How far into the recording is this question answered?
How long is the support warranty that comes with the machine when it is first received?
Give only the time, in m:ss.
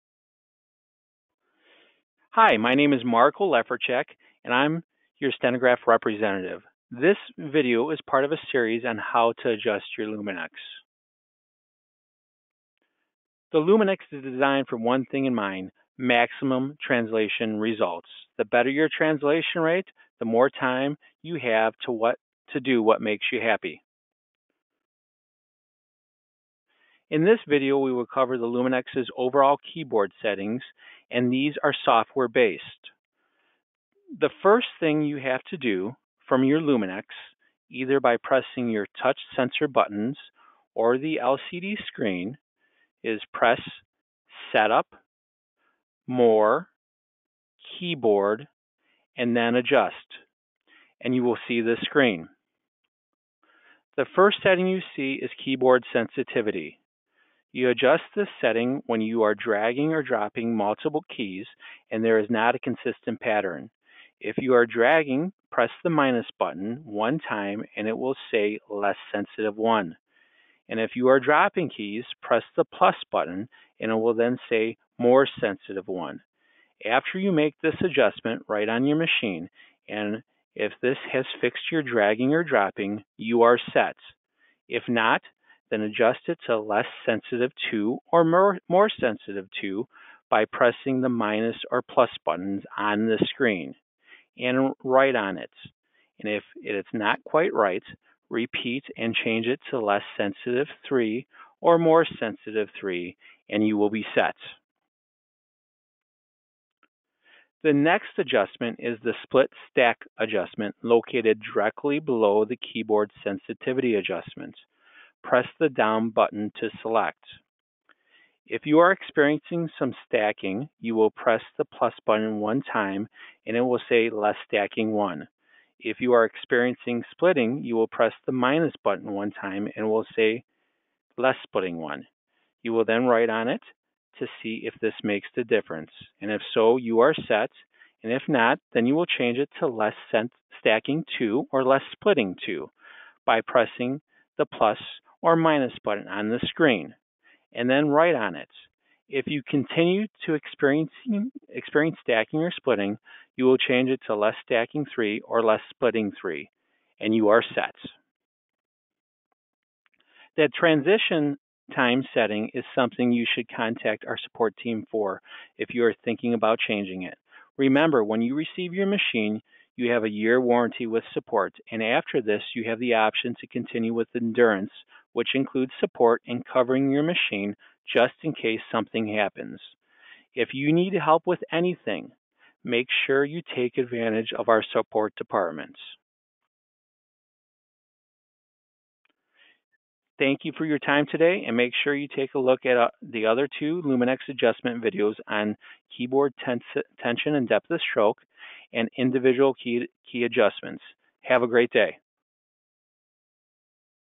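2:50.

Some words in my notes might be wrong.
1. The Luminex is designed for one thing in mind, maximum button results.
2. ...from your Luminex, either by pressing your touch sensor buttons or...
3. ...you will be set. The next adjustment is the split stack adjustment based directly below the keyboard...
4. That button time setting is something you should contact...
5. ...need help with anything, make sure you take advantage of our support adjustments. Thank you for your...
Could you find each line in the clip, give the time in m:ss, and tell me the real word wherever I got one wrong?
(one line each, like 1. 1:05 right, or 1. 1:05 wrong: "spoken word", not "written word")
1. 0:13 wrong: "translation", not "button"
2. 0:36 right
3. 1:43 wrong: "located", not "based"
4. 2:40 wrong: "transition", not "button"
5. 3:00 wrong: "departments", not "adjustments".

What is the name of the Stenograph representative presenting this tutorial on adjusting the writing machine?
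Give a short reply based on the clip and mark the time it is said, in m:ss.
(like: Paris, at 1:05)
Mark Oleferchik, at 0:03.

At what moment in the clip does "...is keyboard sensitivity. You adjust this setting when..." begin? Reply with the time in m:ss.
0:55.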